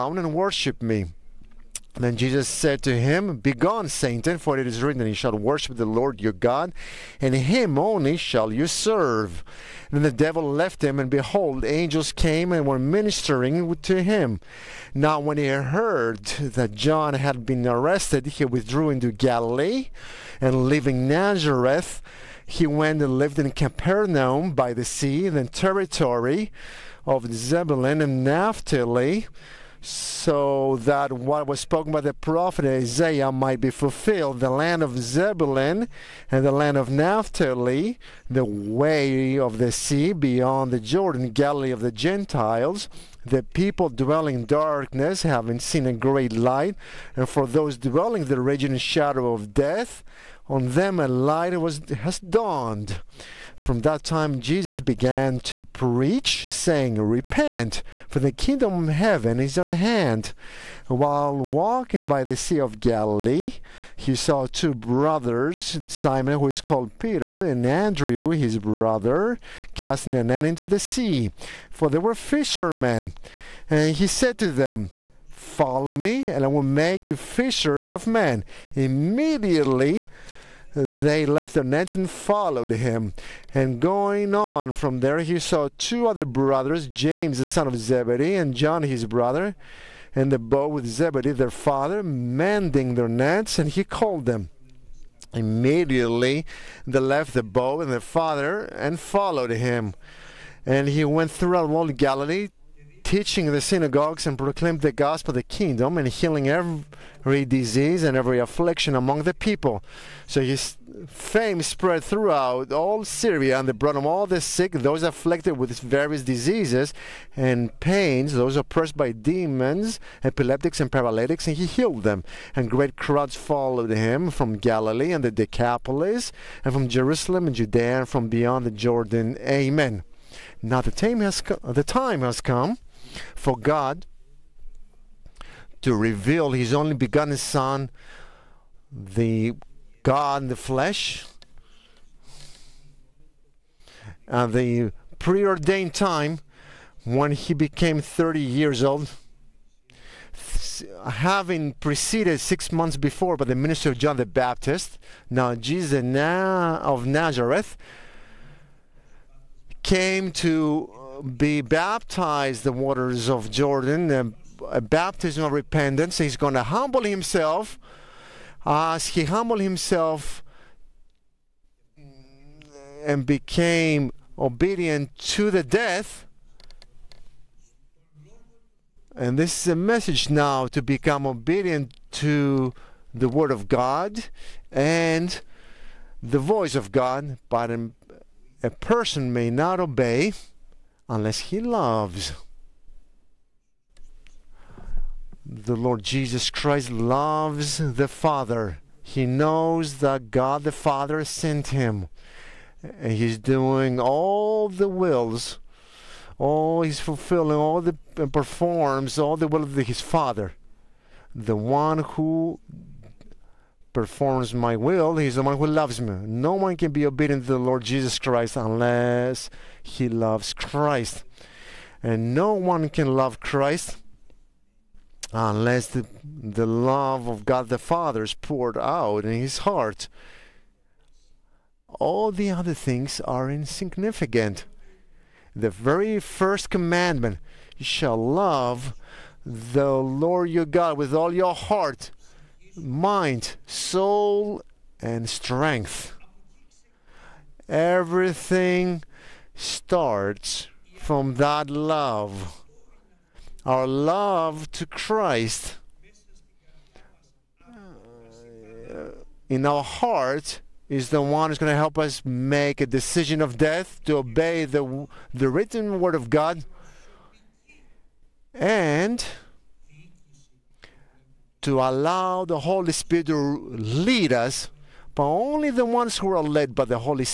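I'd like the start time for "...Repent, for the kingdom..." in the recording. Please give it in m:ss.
0:57.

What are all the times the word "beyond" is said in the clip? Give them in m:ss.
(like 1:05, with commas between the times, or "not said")
0:40, 2:08.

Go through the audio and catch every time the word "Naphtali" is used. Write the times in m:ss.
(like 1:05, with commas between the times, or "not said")
0:28, 0:36.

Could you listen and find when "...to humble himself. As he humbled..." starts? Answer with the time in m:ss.
2:46.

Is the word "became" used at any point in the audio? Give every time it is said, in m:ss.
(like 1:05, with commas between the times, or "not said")
2:27, 2:53.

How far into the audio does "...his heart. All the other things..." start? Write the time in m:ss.
3:49.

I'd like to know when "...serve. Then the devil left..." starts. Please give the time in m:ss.
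0:08.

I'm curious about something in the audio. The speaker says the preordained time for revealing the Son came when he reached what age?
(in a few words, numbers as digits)
30.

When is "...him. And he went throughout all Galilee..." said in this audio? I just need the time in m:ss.
1:39.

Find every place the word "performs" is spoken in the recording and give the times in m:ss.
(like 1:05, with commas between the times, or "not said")
3:28, 3:33.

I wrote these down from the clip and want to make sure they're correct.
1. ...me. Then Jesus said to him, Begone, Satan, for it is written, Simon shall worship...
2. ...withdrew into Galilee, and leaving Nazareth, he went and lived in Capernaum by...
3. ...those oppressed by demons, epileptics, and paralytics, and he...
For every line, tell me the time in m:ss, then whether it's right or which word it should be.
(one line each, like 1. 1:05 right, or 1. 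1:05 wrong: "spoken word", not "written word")
1. 0:00 wrong: "You", not "Simon"
2. 0:18 right
3. 1:58 right.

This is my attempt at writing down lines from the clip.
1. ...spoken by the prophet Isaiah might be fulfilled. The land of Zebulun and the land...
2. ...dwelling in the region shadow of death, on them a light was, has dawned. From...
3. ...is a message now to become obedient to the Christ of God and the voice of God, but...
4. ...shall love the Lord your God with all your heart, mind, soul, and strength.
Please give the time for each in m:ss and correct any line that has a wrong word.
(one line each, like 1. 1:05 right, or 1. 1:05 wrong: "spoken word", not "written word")
1. 0:31 right
2. 0:47 right
3. 2:59 wrong: "Word", not "Christ"
4. 3:57 right.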